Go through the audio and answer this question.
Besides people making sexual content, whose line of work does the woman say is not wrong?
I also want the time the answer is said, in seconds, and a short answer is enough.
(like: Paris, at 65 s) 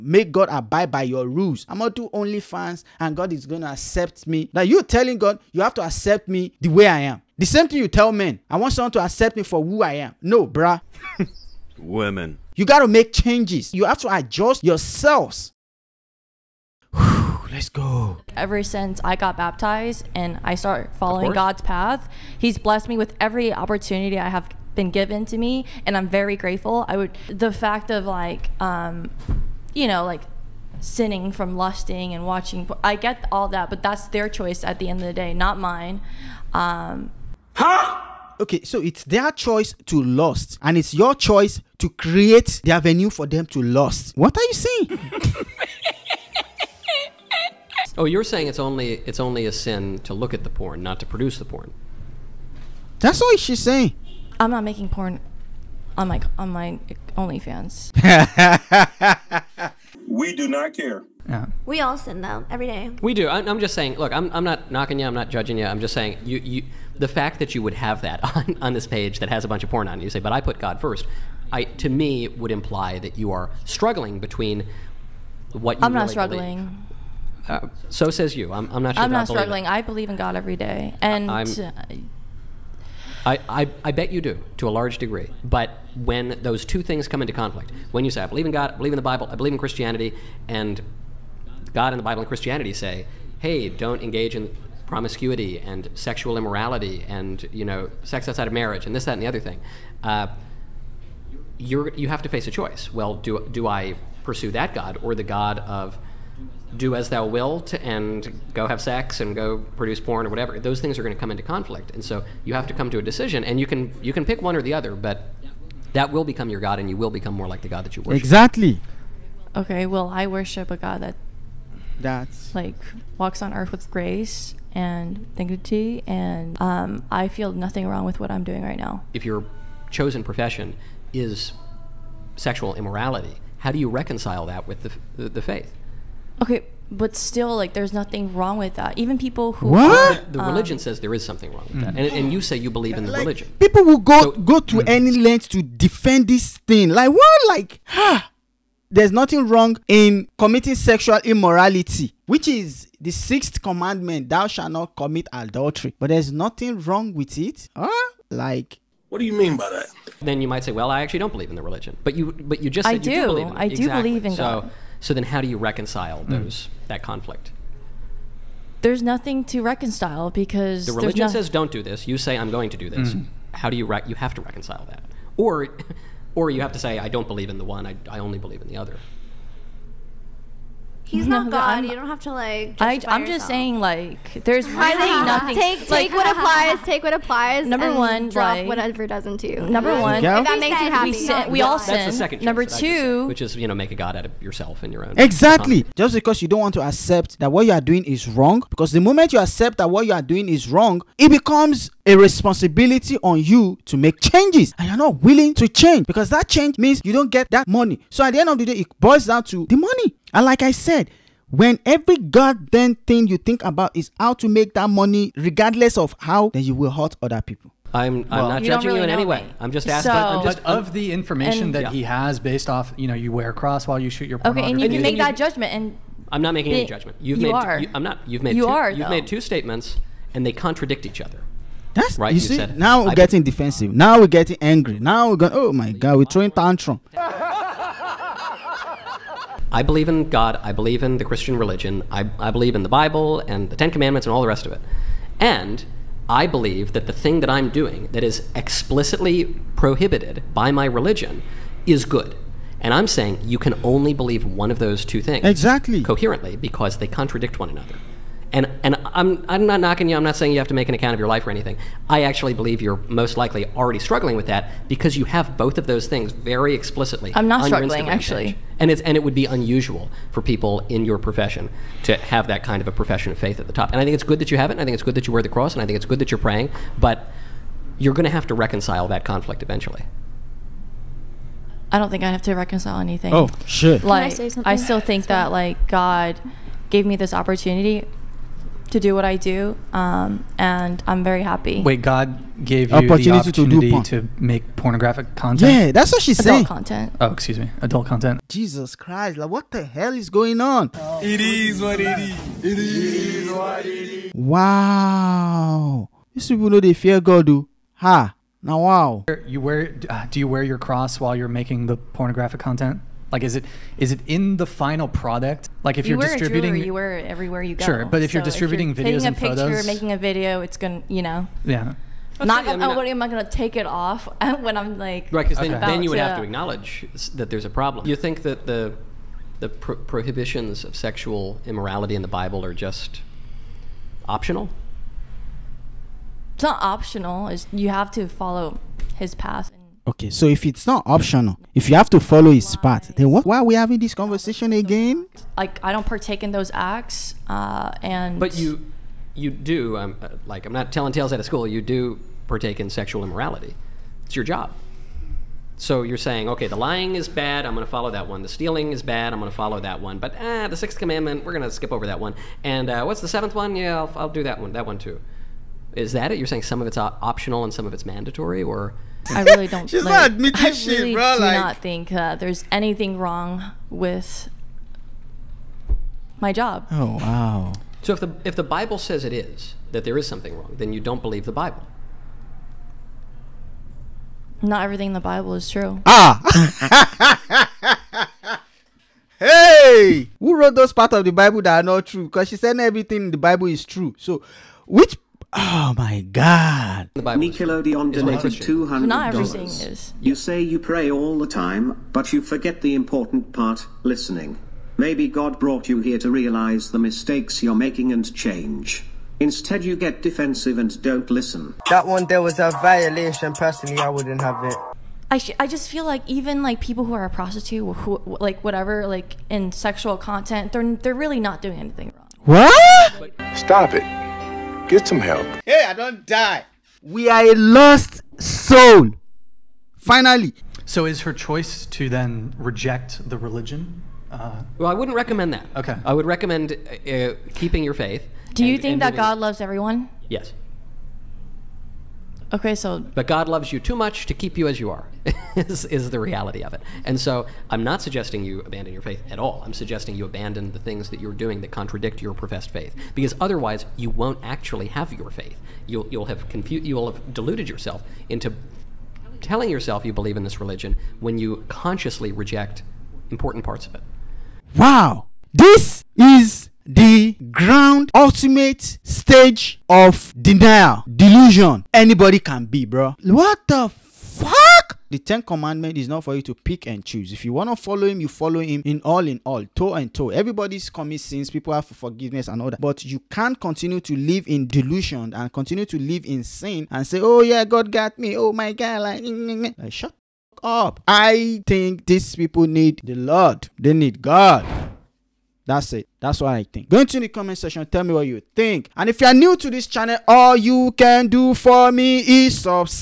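prostitute, at 417 s.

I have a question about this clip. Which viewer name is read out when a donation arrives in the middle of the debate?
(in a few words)
Nickelodeon.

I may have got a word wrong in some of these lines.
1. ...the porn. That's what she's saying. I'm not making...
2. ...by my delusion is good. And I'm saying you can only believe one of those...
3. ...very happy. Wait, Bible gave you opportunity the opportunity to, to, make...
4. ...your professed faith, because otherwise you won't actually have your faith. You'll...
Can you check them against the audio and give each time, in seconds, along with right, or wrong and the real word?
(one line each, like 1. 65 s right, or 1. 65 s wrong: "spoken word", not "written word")
1. 51 s right
2. 250 s wrong: "religion", not "delusion"
3. 291 s wrong: "God", not "Bible"
4. 452 s right.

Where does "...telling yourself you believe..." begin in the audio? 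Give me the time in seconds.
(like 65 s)
459 s.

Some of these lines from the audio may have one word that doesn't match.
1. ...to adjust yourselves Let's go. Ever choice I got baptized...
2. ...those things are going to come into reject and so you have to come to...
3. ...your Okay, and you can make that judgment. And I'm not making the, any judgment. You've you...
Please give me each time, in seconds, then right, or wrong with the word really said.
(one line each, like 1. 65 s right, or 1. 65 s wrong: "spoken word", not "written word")
1. 13 s wrong: "since", not "choice"
2. 110 s wrong: "conflict", not "reject"
3. 224 s right.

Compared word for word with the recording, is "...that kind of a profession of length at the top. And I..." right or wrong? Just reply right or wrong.
wrong.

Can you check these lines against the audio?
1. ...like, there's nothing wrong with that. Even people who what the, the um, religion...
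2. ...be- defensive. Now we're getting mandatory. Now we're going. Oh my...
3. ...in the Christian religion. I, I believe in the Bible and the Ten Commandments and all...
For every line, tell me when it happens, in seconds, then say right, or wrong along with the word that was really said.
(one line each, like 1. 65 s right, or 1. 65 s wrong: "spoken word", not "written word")
1. 137 s right
2. 233 s wrong: "angry", not "mandatory"
3. 241 s right.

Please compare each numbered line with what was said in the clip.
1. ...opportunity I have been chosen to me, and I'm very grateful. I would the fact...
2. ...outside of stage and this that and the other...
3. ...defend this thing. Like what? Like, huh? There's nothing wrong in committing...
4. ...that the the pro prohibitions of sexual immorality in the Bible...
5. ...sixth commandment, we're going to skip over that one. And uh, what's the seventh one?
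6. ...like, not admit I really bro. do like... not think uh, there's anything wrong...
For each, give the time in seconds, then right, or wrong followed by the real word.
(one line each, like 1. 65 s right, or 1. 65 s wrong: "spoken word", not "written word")
1. 23 s wrong: "given", not "chosen"
2. 98 s wrong: "marriage", not "stage"
3. 145 s right
4. 328 s right
5. 360 s right
6. 370 s right.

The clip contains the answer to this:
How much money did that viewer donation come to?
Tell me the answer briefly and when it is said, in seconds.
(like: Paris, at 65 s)
$200, at 398 s.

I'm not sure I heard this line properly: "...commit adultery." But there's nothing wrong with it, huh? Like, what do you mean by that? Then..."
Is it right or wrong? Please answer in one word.
right.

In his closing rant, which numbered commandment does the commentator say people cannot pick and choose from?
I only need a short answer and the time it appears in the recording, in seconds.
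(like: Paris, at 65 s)
10th commandment, at 475 s.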